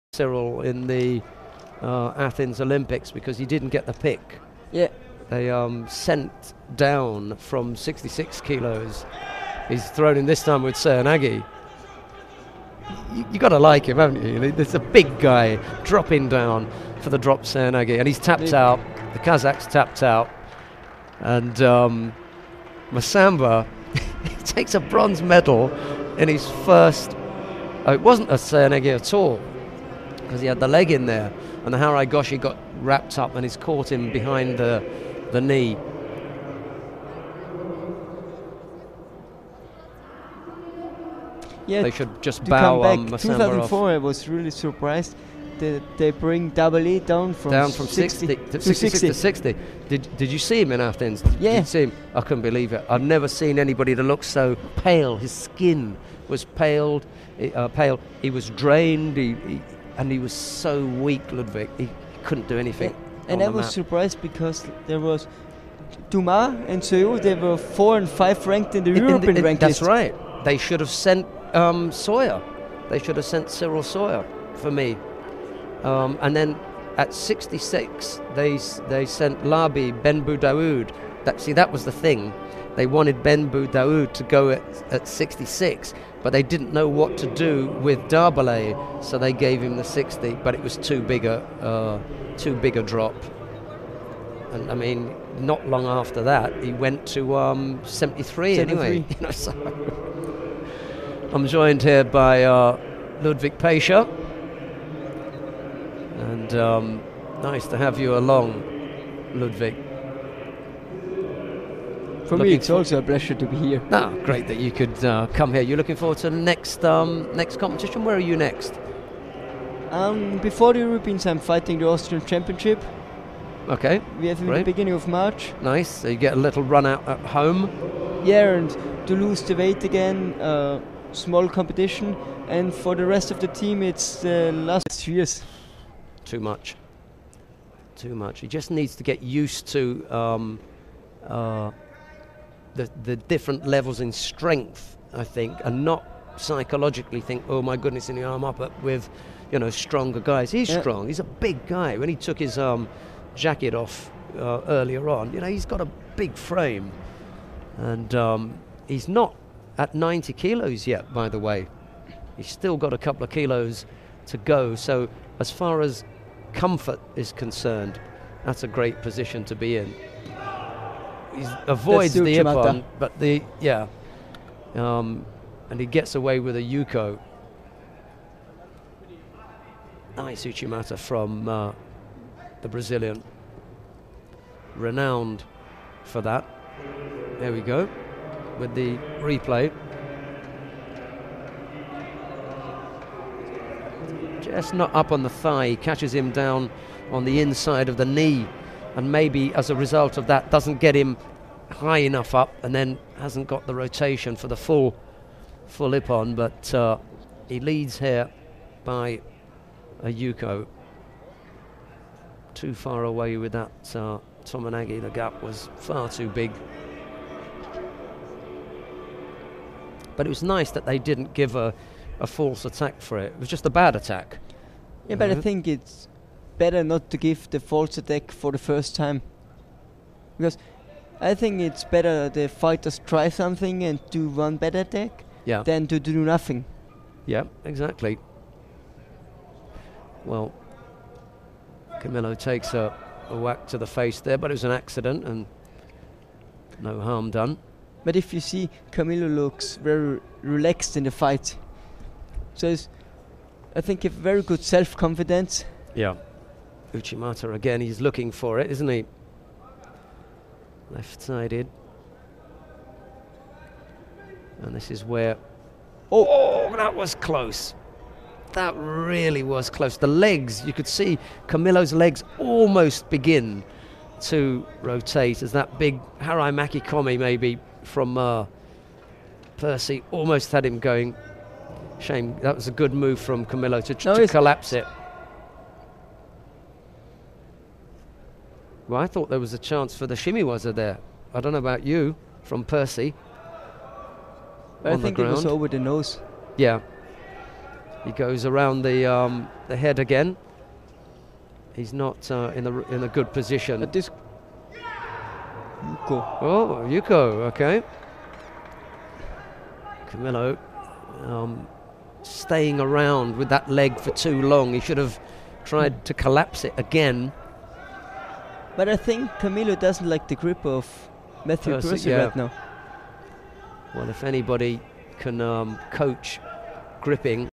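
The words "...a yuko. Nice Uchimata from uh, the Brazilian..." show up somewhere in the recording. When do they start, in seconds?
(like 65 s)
176 s.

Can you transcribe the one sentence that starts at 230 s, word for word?
Because I think it's better the fighters try something and do one bad attack yeah.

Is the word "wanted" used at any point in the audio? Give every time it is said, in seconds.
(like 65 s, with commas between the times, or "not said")
82 s.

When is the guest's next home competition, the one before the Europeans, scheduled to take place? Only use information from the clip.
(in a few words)
beginning of March.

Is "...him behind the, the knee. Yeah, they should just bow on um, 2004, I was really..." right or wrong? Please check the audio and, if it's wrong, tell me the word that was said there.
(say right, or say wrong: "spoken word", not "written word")
right.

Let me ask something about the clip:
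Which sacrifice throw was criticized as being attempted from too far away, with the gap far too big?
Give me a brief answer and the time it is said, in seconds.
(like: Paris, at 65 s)
Tomoe Nage, at 214 s.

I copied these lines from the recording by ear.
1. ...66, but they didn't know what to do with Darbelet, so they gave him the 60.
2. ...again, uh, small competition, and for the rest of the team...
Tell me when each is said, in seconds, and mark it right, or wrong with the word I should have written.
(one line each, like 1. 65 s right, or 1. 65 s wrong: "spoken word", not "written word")
1. 85 s right
2. 129 s right.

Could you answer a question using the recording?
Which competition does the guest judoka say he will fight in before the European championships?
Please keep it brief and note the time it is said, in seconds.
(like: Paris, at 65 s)
Austrian Championship, at 121 s.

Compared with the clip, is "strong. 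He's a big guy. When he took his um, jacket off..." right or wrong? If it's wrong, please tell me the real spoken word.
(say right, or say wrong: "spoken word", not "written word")
right.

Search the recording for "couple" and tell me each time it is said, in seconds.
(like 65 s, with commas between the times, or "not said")
162 s.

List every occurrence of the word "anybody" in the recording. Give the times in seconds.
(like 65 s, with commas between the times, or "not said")
53 s, 324 s.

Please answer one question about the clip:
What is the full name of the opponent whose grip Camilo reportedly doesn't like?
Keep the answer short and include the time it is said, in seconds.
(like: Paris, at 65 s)
Matthew Percy, at 321 s.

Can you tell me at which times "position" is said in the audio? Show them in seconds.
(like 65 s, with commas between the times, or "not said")
169 s, 303 s.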